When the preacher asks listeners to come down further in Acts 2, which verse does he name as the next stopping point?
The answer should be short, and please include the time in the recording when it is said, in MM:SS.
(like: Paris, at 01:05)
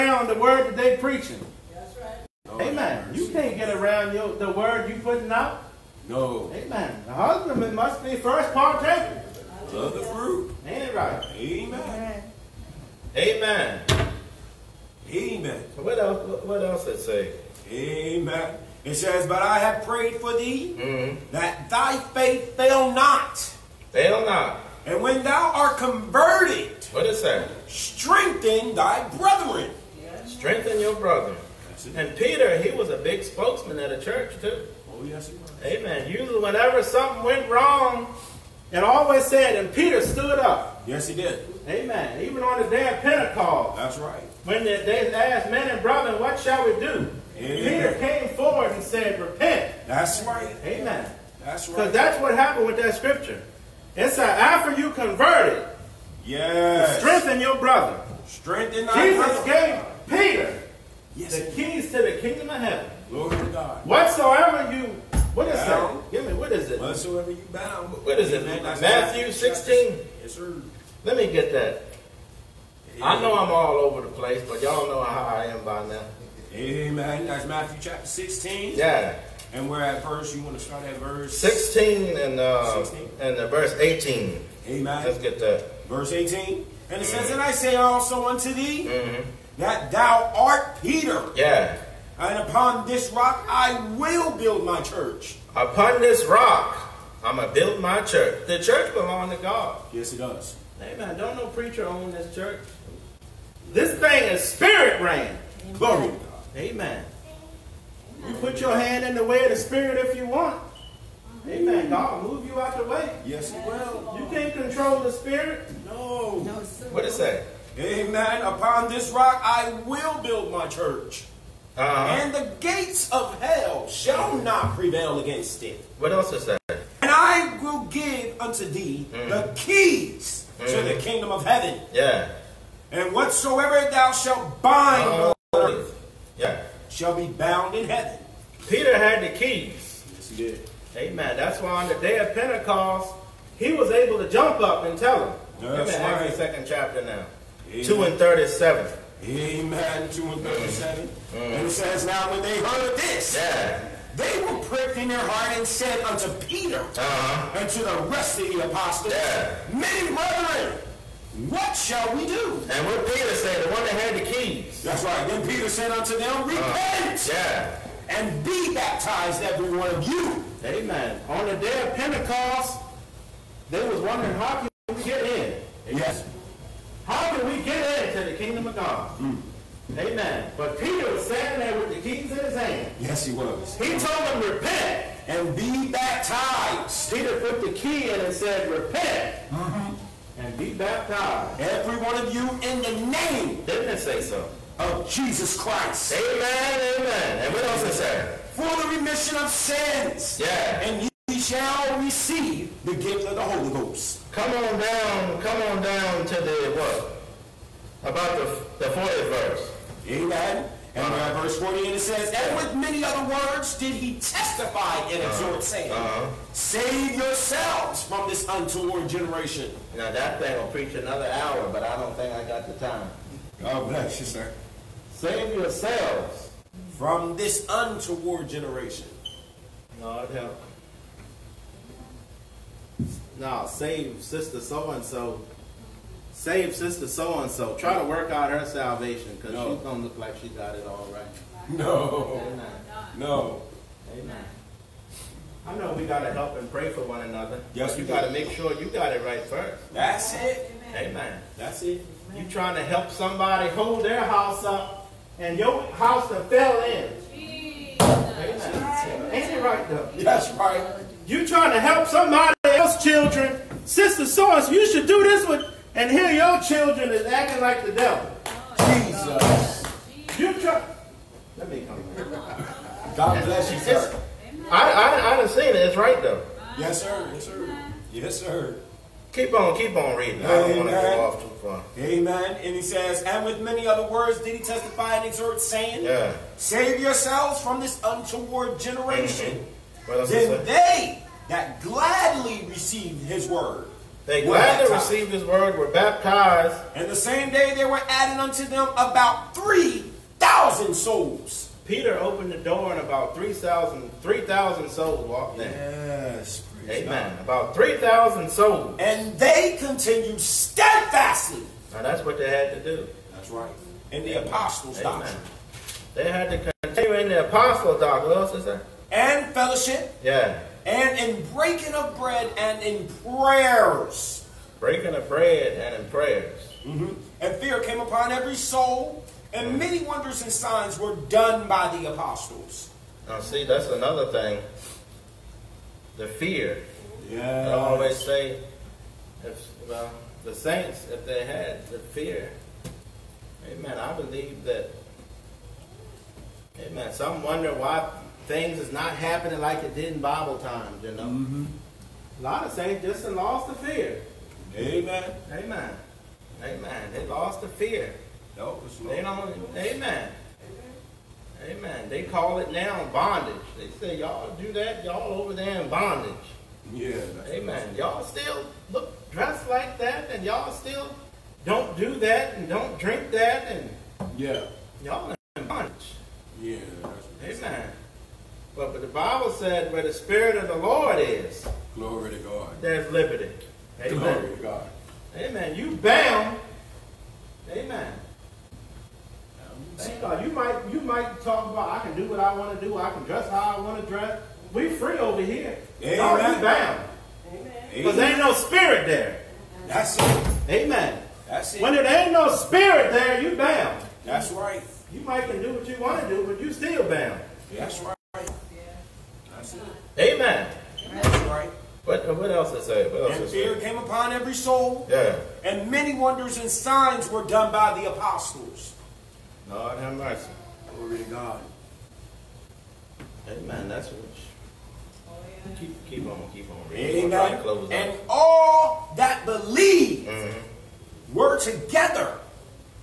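40, at 03:28.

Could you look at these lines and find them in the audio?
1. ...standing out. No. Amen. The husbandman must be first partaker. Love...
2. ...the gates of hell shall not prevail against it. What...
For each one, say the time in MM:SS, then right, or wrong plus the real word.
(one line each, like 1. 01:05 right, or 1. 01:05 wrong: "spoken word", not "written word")
1. 00:05 wrong: "putting", not "standing"
2. 02:02 right.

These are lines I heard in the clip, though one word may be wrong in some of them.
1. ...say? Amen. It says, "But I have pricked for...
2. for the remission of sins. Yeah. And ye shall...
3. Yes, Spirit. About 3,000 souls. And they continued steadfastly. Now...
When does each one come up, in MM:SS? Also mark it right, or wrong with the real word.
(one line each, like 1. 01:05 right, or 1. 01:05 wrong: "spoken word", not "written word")
1. 00:16 wrong: "prayed", not "pricked"
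2. 03:18 right
3. 05:05 wrong: "Amen", not "Spirit".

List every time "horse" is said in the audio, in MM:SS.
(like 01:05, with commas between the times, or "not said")
not said.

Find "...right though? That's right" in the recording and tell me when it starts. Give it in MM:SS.
04:19.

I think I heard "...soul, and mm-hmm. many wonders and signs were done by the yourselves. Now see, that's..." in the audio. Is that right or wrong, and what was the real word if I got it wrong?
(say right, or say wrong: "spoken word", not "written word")
wrong: "apostles", not "yourselves".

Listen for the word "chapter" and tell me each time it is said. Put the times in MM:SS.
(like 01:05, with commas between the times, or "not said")
01:17, 02:26.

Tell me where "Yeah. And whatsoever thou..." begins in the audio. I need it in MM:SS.
02:11.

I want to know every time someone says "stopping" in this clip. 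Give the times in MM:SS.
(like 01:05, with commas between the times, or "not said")
not said.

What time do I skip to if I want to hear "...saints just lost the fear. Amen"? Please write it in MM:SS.
05:52.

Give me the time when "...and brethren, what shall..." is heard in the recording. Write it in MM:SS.
00:45.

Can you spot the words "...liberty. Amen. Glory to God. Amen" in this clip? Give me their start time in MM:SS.
06:23.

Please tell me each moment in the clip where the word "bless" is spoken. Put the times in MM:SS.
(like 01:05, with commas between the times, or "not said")
03:43, 04:33.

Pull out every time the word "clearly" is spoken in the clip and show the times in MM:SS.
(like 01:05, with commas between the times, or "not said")
not said.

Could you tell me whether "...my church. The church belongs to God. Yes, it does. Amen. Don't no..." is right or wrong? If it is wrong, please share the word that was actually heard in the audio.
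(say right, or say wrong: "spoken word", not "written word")
right.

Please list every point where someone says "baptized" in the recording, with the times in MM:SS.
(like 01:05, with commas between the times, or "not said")
02:48, 03:05, 03:10, 04:55.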